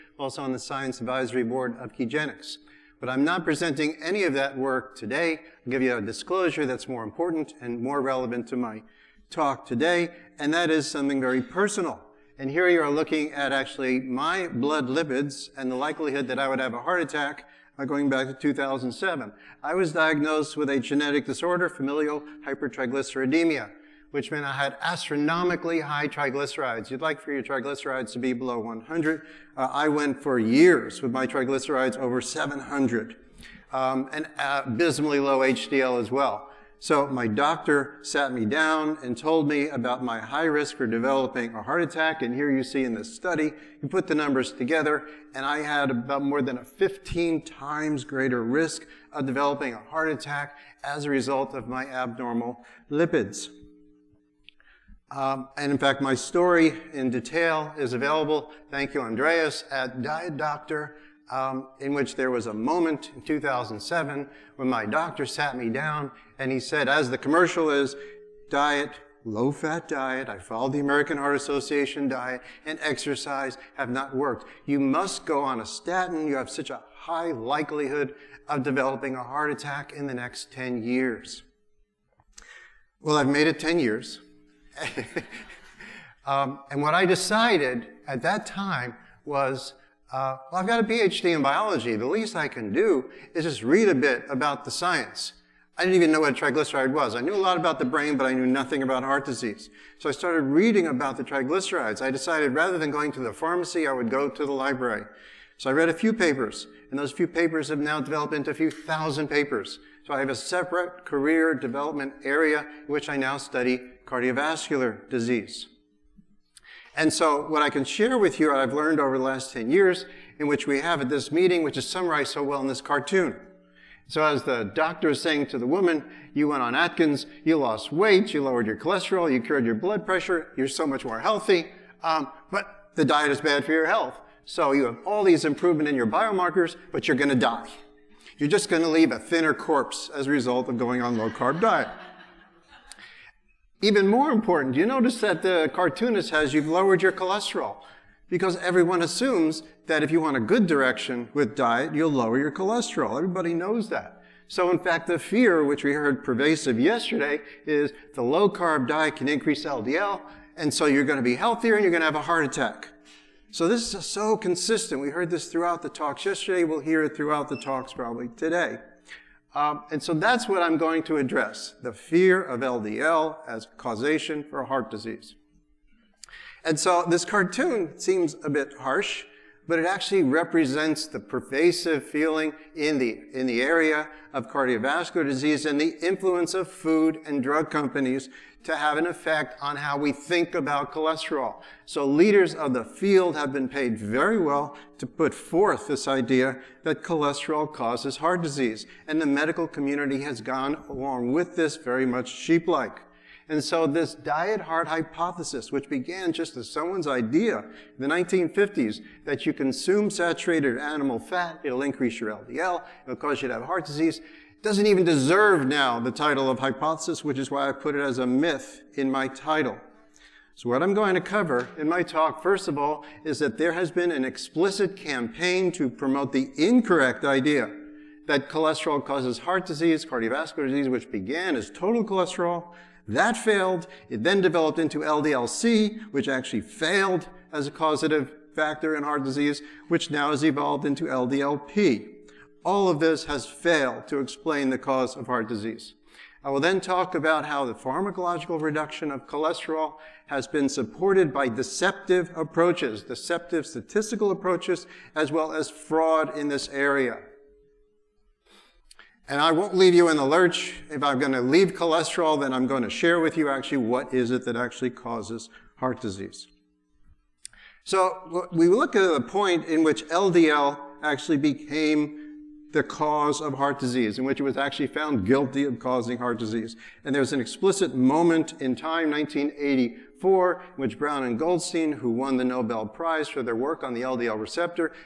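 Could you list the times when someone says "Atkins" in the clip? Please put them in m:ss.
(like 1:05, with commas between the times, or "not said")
2:06.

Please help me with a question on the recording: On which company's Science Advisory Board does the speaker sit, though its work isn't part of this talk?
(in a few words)
Kegenix.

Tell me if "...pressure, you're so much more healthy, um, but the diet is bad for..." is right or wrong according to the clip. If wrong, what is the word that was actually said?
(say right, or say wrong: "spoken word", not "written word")
right.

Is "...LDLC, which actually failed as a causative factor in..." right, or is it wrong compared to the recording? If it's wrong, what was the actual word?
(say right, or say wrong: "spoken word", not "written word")
right.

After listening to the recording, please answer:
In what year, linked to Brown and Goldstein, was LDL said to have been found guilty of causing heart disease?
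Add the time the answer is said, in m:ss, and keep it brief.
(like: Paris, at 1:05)
1984, at 4:39.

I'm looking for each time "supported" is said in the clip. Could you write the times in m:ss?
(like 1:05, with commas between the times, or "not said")
4:10.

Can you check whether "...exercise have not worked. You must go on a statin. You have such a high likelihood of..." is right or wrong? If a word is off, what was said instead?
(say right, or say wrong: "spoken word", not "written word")
right.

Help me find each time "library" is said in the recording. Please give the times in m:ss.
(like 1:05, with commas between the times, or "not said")
1:44.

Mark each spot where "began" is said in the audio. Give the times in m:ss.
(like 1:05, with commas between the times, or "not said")
3:25, 3:51.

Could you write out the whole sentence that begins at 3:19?
And the medical community has gone along with this very much sheep-like.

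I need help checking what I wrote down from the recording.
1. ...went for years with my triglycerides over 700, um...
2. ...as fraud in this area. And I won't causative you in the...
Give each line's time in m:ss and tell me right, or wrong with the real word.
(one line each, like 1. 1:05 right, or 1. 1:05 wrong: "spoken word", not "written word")
1. 0:29 right
2. 4:15 wrong: "leave", not "causative".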